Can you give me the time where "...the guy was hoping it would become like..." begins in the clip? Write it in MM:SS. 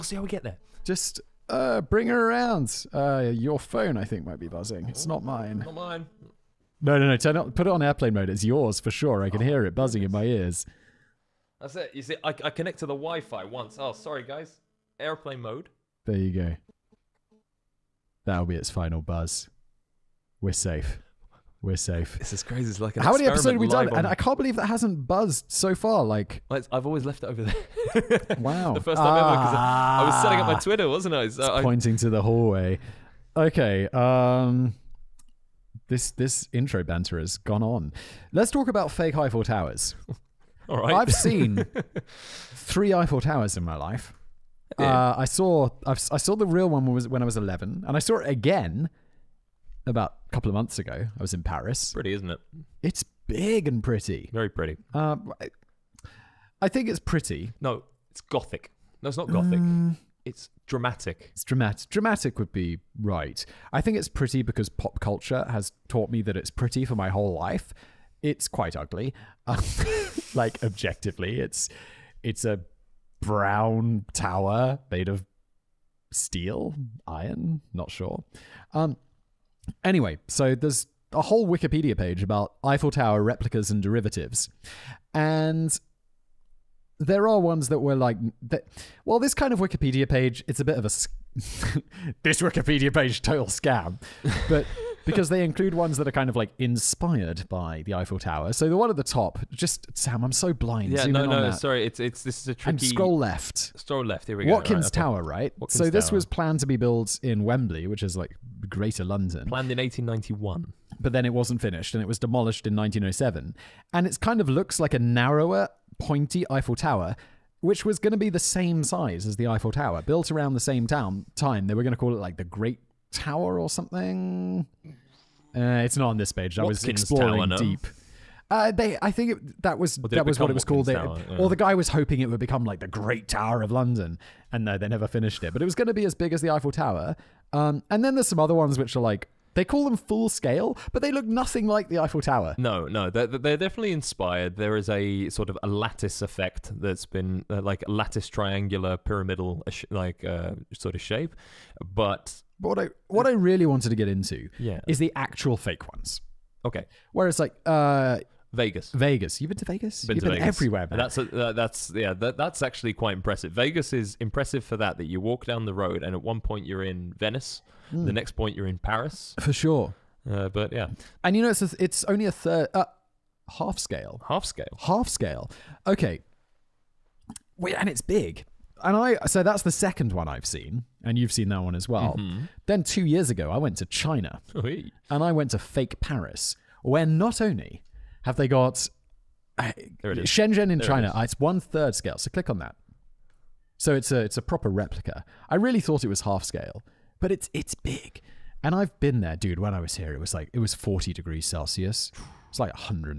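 02:11.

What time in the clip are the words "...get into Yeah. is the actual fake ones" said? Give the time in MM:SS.
02:33.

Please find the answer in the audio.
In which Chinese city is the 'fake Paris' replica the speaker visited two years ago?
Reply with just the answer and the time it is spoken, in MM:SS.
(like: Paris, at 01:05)
Shenzhen, at 03:10.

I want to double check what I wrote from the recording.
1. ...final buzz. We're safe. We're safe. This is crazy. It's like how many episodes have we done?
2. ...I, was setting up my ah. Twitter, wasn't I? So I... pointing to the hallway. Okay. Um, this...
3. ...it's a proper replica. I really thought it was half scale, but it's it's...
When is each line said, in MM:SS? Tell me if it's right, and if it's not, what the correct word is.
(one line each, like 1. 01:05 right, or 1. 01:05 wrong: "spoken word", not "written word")
1. 00:18 right
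2. 00:30 right
3. 03:14 right.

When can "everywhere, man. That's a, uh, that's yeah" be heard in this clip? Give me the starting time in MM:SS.
02:40.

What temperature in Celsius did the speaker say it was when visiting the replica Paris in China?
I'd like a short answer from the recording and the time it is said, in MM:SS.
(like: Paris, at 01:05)
40 degrees, at 03:20.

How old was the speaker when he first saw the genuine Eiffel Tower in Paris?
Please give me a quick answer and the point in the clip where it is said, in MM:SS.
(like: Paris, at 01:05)
11, at 00:47.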